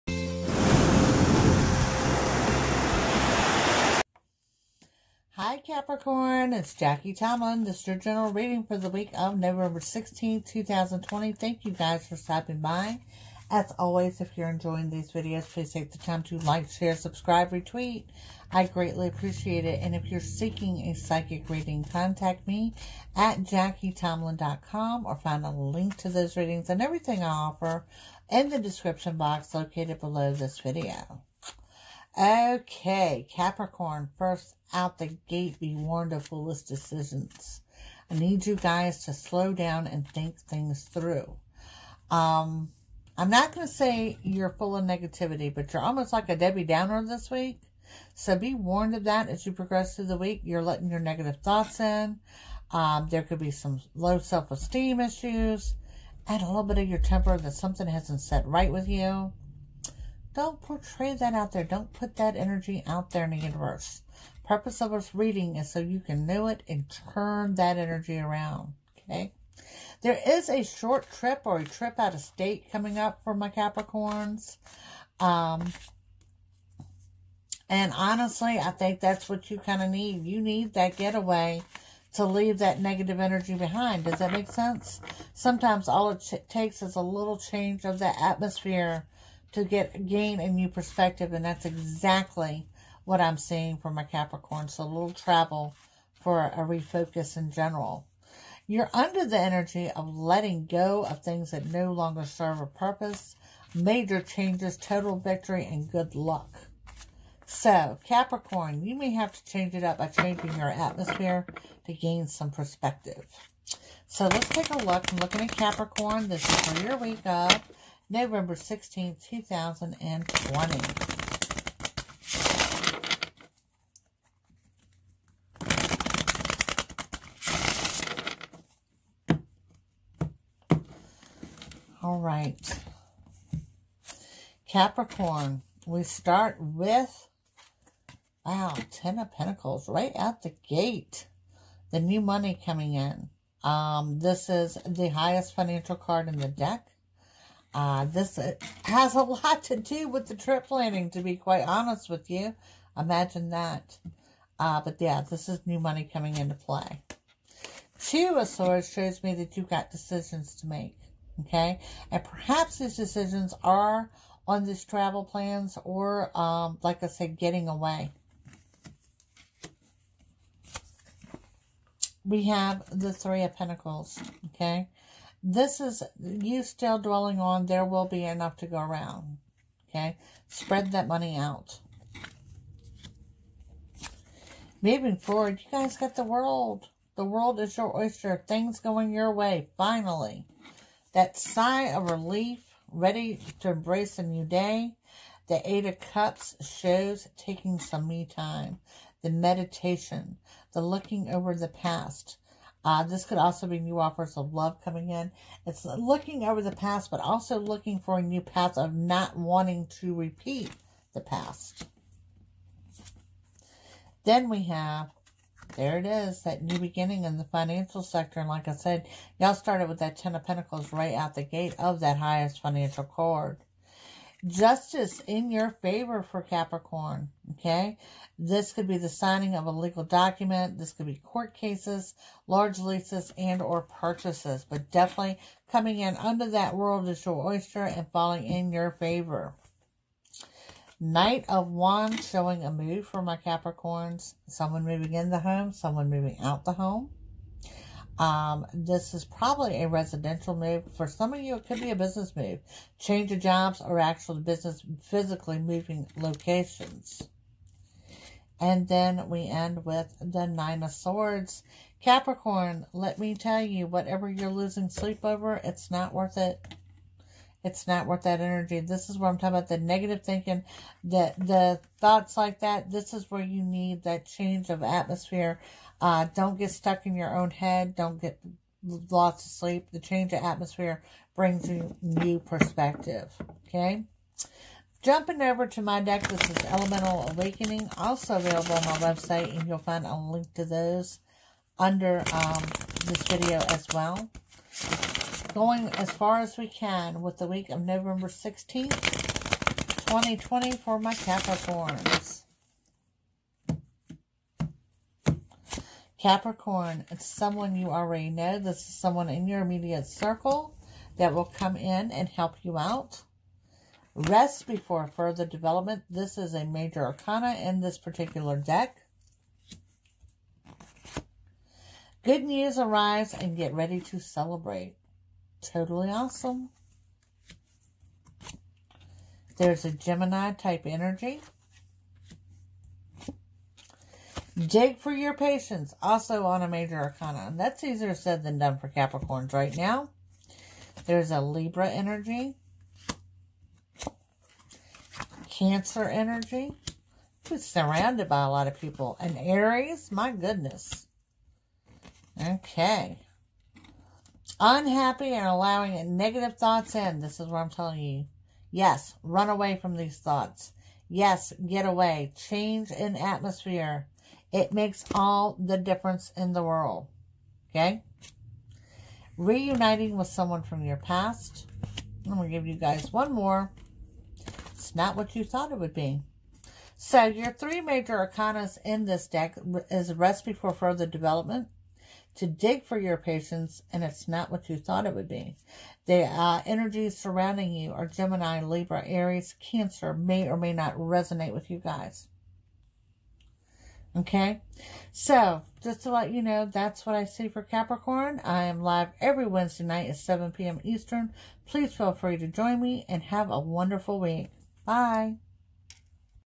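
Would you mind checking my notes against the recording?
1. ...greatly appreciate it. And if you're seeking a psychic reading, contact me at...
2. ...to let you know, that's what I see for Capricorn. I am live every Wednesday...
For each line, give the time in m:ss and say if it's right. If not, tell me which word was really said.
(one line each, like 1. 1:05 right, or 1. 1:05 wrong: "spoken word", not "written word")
1. 0:18 right
2. 6:36 right.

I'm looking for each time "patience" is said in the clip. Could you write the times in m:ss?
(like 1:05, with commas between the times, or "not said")
5:35, 6:23.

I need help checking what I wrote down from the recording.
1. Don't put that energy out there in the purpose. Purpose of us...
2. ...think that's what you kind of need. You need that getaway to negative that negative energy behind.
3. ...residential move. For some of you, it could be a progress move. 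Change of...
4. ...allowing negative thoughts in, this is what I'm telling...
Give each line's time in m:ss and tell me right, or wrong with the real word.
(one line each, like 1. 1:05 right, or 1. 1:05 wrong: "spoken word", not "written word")
1. 1:01 wrong: "universe", not "purpose"
2. 1:18 wrong: "leave", not "negative"
3. 4:09 wrong: "business", not "progress"
4. 5:55 right.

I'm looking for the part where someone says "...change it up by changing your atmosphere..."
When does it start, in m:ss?
1:49.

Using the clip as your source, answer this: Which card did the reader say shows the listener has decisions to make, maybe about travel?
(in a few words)
Two of Swords.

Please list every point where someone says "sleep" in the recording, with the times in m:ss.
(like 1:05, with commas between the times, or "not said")
4:24, 4:39.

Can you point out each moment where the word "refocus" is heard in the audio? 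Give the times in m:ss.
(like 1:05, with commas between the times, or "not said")
1:36.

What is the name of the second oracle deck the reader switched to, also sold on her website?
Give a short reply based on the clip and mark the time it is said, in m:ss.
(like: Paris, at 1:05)
Elemental Awakening, at 4:46.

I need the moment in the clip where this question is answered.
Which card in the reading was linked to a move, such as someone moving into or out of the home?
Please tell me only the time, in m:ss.
4:00.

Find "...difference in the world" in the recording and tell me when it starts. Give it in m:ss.
6:05.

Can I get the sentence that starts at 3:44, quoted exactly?
Justice in your favor for Capricorn, okay?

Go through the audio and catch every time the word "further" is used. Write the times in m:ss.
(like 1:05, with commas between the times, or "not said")
5:15, 6:20.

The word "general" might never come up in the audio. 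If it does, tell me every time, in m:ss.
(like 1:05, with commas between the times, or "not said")
0:07, 1:37.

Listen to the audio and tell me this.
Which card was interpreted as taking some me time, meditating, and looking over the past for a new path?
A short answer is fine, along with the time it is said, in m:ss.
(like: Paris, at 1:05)
Eight of Cups, at 3:15.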